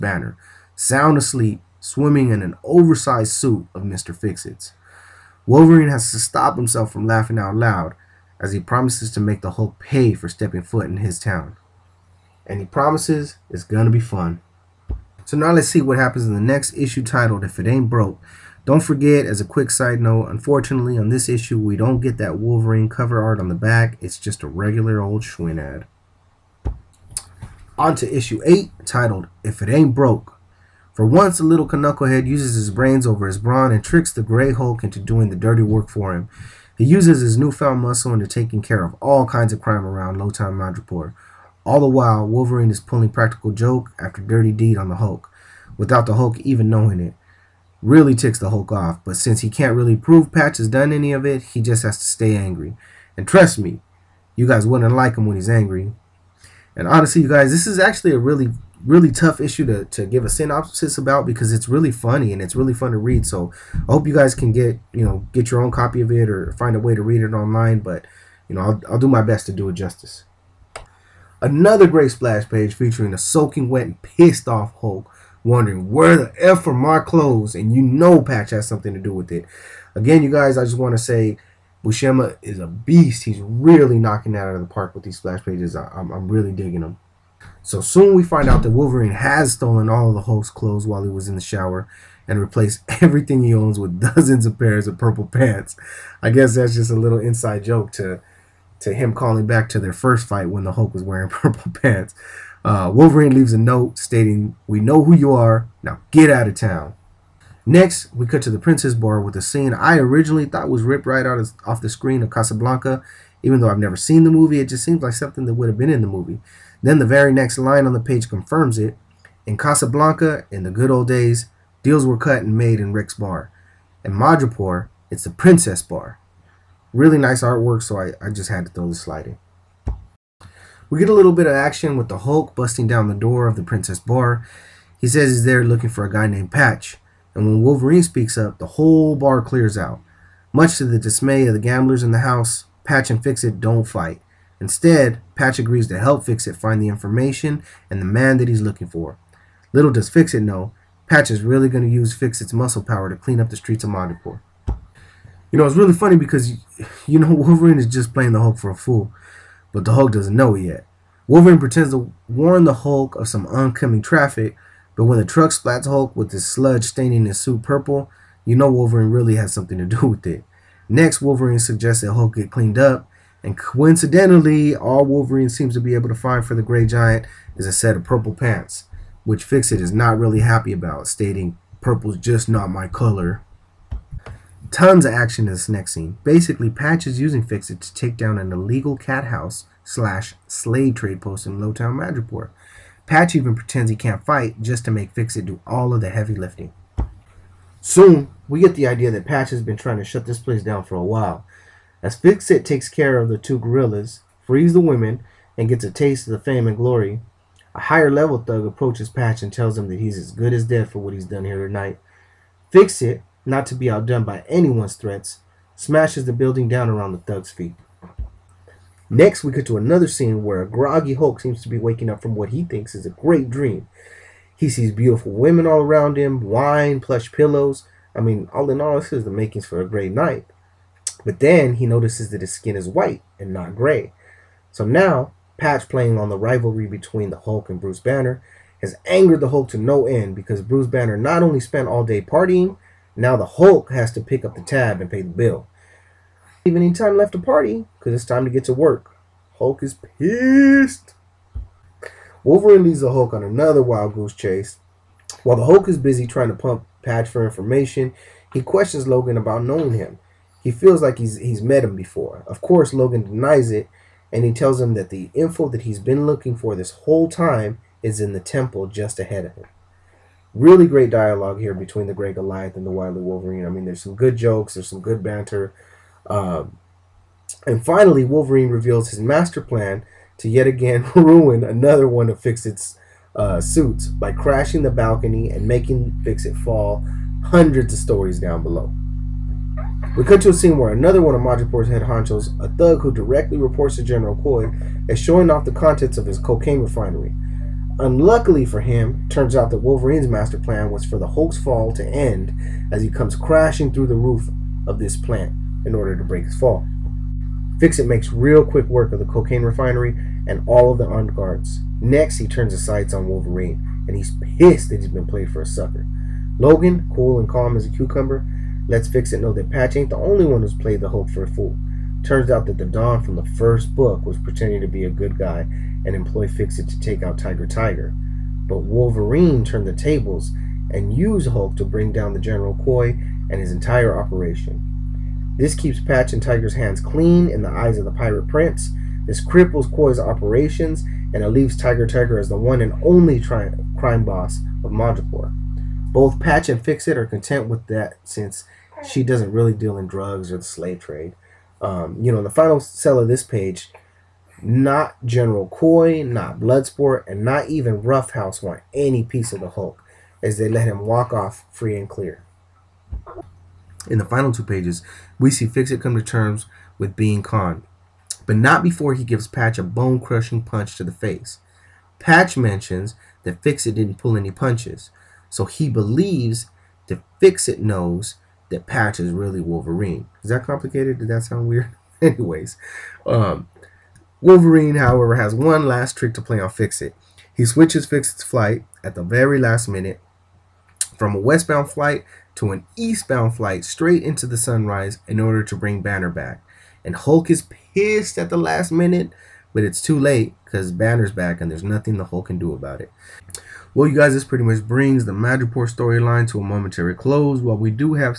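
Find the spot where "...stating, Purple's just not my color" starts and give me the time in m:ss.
3:01.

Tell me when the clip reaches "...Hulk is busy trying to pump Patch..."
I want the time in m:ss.
4:15.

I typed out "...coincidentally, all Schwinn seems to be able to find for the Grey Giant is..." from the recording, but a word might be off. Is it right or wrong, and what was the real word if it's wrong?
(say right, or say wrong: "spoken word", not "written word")
wrong: "Wolverine", not "Schwinn".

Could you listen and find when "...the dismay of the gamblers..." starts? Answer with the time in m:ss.
2:20.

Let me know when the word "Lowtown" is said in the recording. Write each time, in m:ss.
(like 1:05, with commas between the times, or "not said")
0:40, 3:11.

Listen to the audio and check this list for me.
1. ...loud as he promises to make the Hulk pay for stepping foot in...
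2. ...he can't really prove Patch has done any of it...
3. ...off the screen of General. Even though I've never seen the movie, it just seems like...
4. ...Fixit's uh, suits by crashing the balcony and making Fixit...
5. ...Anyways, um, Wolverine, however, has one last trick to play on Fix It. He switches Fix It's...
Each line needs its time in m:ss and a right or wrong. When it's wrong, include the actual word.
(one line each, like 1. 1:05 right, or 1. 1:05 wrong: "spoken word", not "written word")
1. 0:07 right
2. 0:49 right
3. 1:51 wrong: "Casablanca", not "General"
4. 4:42 right
5. 6:22 right.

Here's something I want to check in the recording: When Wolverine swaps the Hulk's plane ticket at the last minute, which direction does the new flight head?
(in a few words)
Eastbound.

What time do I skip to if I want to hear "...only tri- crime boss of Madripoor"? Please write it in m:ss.
5:43.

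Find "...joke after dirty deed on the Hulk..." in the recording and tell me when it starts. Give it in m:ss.
0:43.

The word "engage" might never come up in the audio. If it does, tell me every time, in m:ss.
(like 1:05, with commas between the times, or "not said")
not said.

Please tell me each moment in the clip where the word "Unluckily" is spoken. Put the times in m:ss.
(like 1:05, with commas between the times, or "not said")
4:57.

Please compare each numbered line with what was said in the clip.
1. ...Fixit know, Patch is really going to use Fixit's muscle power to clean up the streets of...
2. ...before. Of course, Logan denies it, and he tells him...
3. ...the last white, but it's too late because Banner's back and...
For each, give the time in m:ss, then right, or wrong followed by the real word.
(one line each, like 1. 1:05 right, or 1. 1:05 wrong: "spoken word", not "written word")
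1. 2:30 right
2. 4:21 right
3. 6:38 wrong: "minute", not "white".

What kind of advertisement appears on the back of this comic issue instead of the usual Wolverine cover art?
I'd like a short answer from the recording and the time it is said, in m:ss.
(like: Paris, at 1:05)
Schwinn ad, at 0:25.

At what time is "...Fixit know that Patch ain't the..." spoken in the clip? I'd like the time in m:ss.
5:19.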